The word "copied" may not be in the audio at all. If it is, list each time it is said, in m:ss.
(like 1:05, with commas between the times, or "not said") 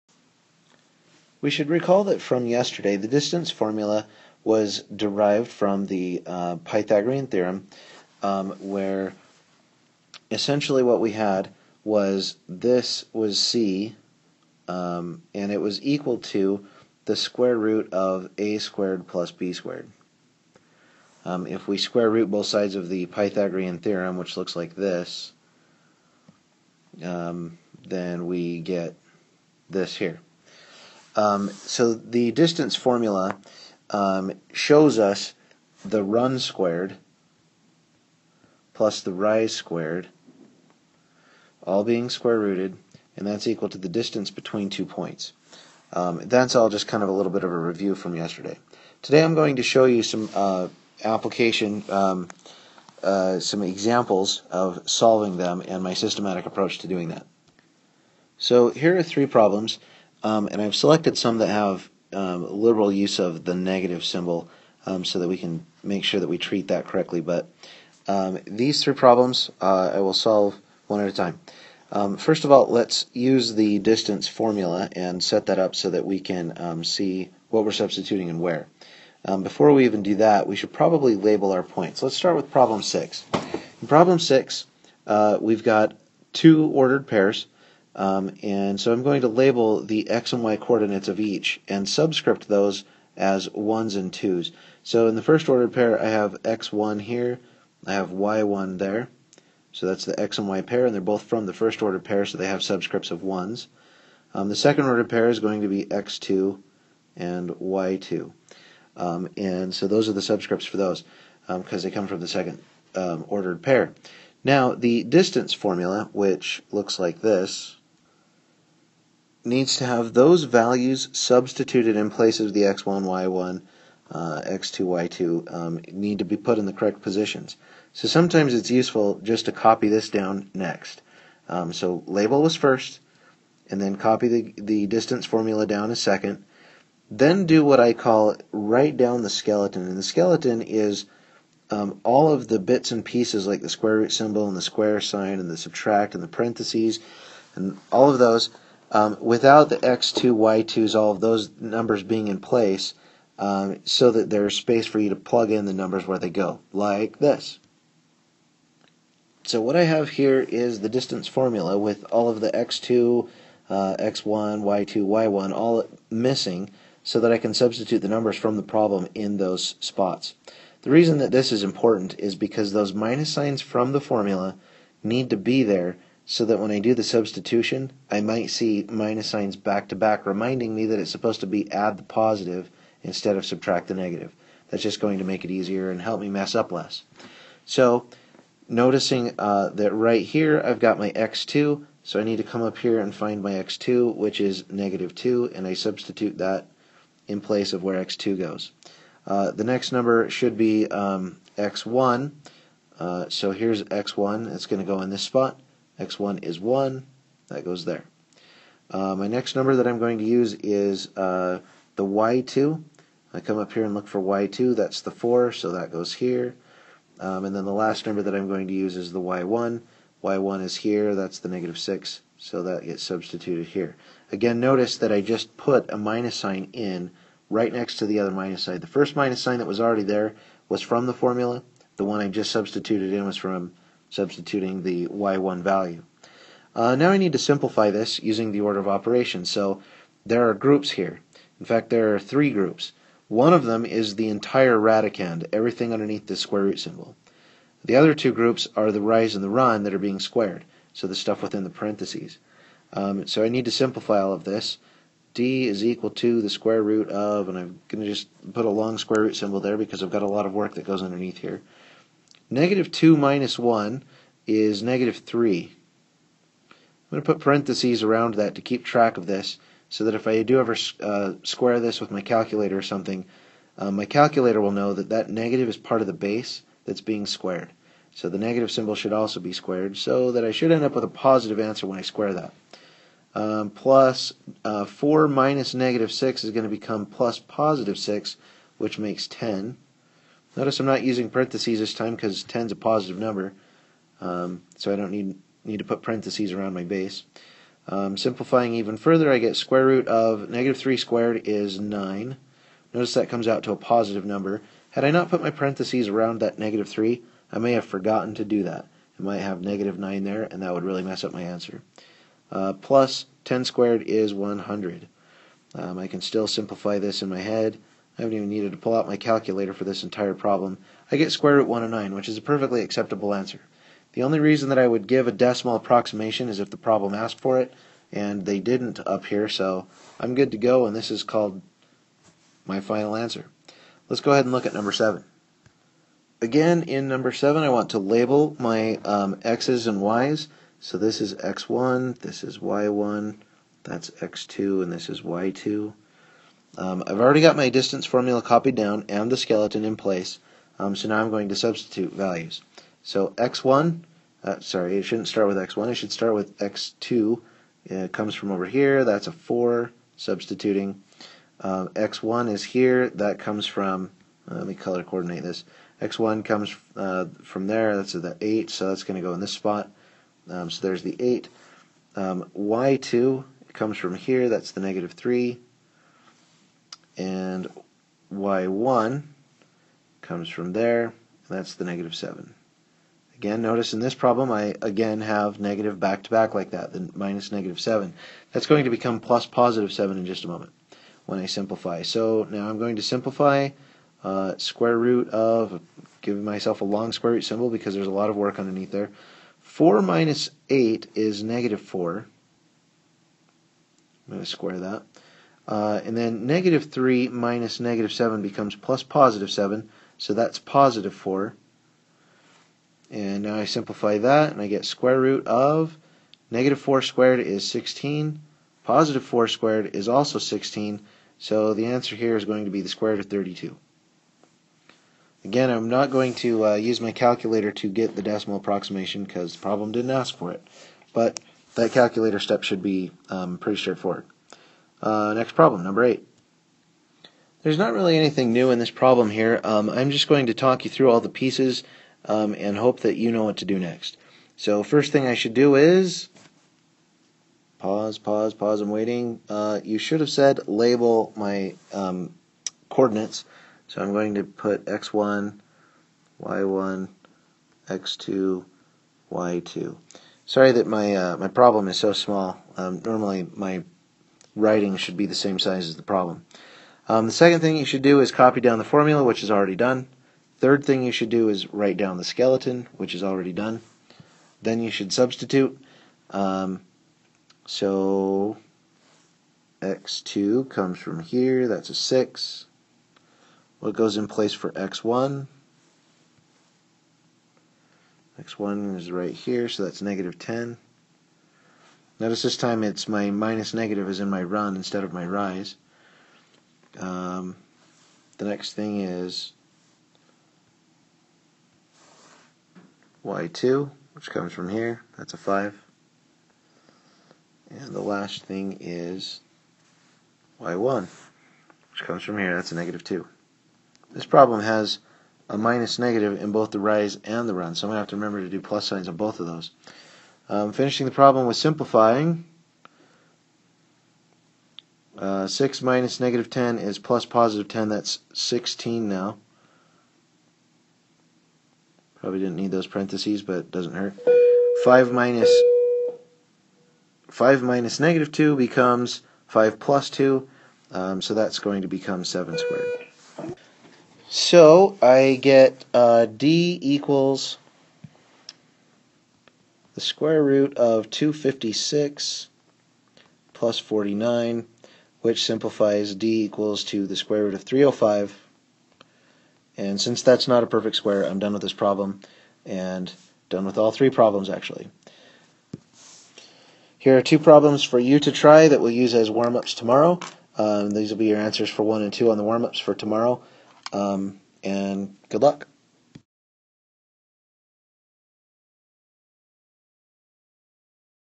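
5:48.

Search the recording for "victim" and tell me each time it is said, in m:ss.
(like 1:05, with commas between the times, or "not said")
not said.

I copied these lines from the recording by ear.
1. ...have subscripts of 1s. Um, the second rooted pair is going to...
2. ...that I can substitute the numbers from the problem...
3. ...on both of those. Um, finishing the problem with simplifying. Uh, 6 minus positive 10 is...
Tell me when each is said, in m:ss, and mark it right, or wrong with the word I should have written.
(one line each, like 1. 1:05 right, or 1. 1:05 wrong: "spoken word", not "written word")
1. 1:42 wrong: "ordered", not "rooted"
2. 2:47 right
3. 8:39 wrong: "negative", not "positive".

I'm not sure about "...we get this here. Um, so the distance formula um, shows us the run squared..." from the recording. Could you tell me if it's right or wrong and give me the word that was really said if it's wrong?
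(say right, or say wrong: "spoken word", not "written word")
right.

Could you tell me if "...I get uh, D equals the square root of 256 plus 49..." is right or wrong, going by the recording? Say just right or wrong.
right.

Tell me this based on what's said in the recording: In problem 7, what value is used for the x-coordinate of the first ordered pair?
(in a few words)
8.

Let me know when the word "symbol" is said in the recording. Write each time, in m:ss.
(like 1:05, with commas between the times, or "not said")
1:04, 2:24, 4:06, 4:19, 4:38, 6:37.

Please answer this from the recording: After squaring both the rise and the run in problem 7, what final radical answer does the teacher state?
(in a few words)
square root of 32.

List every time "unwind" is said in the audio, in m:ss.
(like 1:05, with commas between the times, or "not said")
not said.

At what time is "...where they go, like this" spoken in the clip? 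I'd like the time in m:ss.
2:36.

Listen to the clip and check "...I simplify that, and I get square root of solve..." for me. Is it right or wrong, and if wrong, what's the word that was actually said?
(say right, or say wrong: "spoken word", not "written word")
wrong: "negative", not "solve".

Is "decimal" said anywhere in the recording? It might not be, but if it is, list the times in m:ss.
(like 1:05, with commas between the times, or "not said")
5:25, 7:08.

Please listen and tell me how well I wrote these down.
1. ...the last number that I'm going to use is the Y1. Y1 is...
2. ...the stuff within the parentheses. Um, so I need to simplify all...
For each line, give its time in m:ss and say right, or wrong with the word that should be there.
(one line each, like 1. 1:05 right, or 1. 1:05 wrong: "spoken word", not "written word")
1. 3:37 right
2. 4:11 right.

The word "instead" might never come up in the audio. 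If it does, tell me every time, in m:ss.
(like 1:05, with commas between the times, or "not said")
3:03, 8:14.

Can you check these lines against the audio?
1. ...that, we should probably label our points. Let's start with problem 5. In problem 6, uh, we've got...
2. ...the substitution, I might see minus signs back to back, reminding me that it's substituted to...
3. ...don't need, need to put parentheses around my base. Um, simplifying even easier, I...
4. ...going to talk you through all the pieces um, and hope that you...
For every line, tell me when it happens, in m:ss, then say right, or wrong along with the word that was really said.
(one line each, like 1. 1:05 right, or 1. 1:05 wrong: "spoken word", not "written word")
1. 1:20 wrong: "6", not "5"
2. 2:56 wrong: "supposed", not "substituted"
3. 4:54 wrong: "further", not "easier"
4. 7:20 right.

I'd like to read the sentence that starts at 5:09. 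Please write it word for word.
I might have negative 9 there, and that would really mess up my answer.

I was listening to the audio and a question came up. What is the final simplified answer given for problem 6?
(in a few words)
square root of 109.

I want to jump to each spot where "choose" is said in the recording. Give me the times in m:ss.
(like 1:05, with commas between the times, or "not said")
not said.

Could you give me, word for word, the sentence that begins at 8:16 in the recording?
Um, the next thing is y2, which comes from here.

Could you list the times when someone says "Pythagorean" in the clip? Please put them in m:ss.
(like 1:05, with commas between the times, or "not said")
0:06, 0:23.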